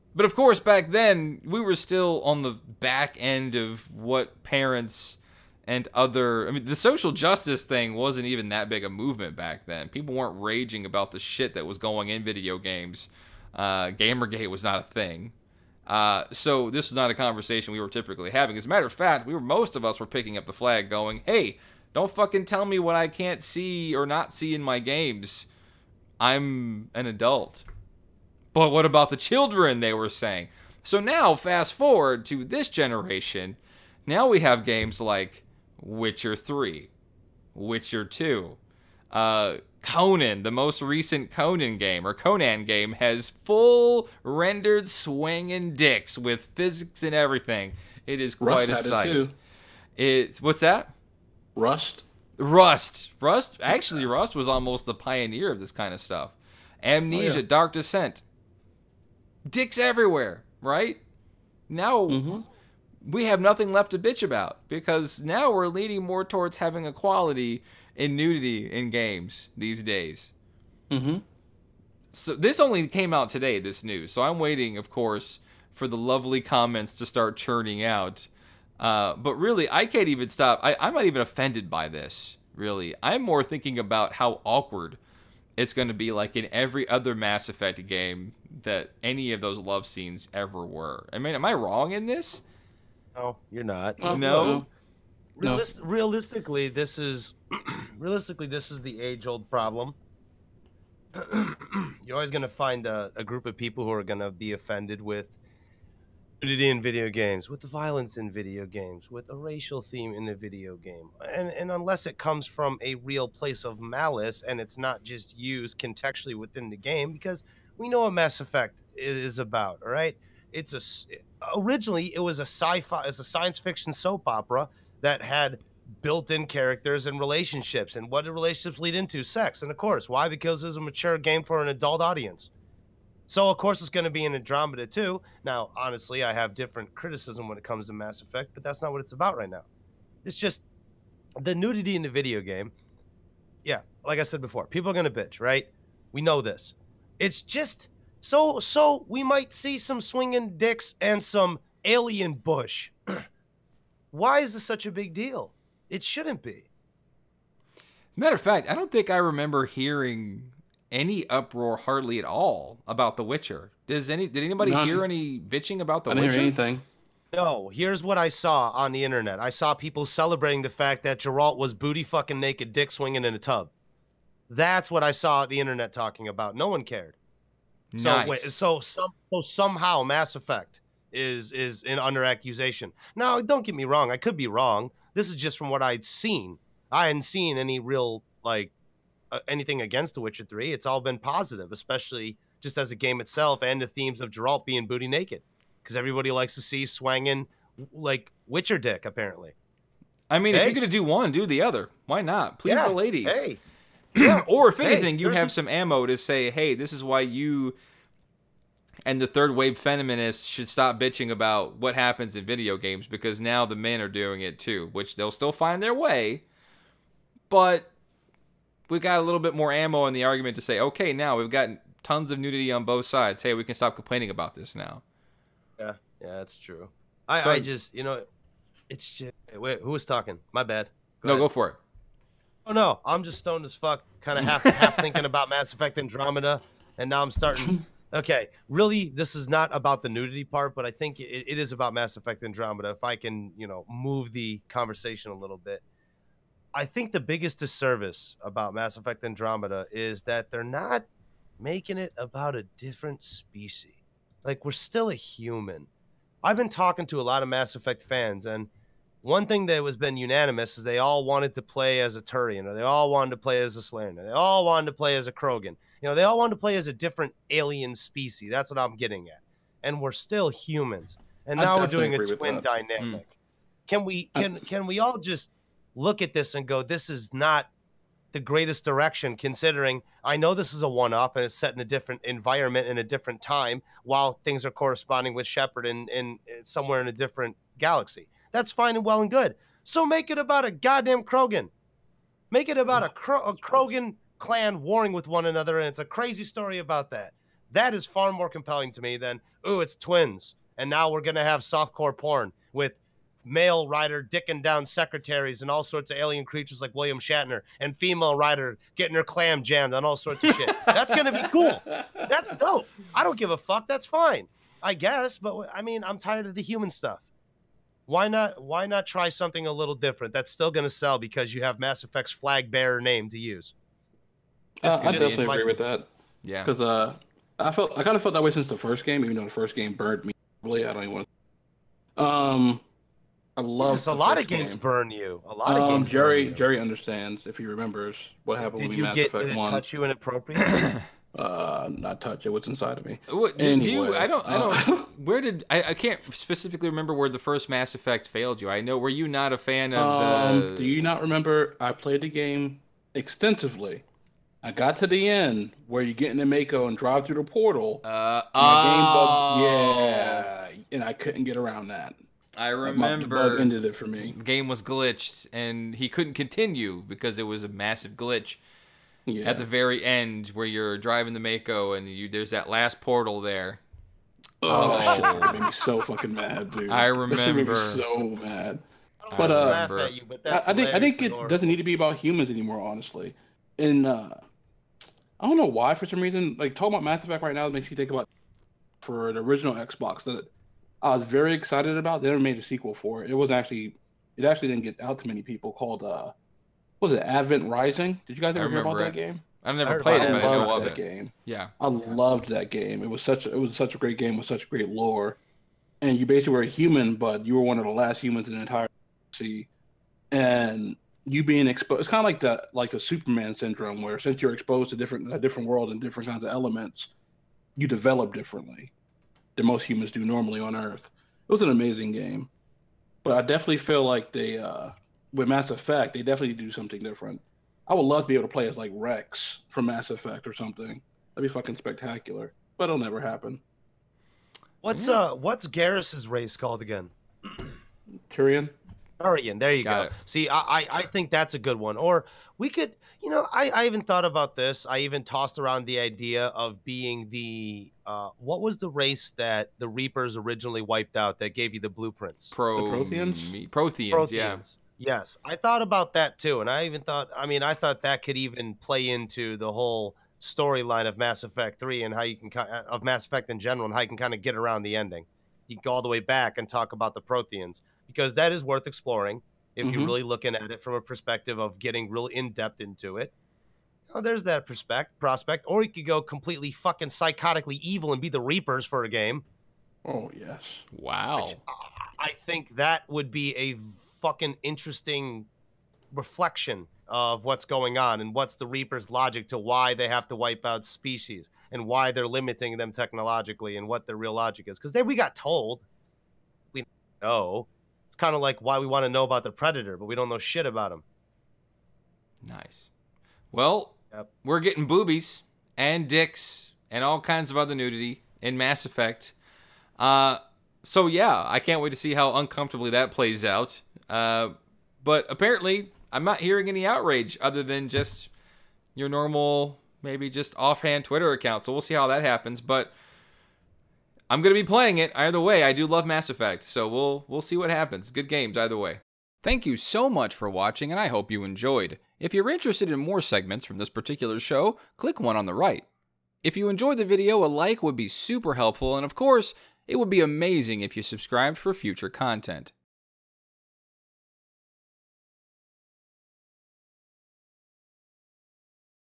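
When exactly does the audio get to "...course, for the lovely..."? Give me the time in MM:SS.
01:14.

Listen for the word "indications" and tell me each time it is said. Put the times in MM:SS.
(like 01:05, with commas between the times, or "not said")
not said.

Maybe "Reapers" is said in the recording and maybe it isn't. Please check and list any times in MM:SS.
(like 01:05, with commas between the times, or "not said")
07:29, 07:58, 08:08.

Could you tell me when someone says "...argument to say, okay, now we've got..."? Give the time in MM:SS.
03:40.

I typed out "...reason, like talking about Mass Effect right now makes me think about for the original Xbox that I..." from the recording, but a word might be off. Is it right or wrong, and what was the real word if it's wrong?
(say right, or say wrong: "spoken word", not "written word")
right.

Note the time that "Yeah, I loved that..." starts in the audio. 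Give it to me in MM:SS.
06:41.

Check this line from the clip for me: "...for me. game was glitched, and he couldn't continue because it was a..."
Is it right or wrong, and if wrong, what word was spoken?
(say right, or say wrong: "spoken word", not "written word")
right.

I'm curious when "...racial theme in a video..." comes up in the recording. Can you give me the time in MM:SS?
01:49.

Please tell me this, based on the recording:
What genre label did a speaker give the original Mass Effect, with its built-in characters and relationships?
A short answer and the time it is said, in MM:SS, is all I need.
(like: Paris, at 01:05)
science fiction soap opera, at 02:03.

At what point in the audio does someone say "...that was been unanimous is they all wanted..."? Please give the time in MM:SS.
04:19.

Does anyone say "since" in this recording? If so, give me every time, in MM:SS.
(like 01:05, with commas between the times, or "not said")
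05:28, 06:54.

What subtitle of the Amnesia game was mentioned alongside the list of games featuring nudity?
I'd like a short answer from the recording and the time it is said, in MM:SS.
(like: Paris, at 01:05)
Dark Descent, at 00:57.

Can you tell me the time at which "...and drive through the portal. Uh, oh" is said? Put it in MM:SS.
05:56.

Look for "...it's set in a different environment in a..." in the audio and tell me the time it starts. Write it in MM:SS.
04:41.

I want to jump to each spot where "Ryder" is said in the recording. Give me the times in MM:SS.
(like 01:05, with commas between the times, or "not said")
05:03, 05:08.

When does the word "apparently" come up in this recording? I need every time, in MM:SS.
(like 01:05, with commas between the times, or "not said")
03:19, 08:35.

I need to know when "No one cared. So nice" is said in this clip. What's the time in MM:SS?
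02:56.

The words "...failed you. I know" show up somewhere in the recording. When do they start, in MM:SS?
05:48.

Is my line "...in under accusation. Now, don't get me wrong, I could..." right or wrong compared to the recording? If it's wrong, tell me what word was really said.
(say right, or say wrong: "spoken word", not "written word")
right.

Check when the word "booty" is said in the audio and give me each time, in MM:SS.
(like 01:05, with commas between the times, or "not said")
02:51, 03:14.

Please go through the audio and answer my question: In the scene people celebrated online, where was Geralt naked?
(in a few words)
In a tub.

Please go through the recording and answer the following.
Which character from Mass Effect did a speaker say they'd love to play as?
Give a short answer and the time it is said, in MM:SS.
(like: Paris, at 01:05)
Rex, at 07:08.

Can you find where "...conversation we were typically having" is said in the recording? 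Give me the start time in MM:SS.
00:17.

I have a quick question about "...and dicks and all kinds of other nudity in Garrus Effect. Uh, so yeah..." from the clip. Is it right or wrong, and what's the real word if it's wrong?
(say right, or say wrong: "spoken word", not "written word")
wrong: "Mass", not "Garrus".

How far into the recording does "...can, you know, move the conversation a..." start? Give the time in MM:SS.
04:03.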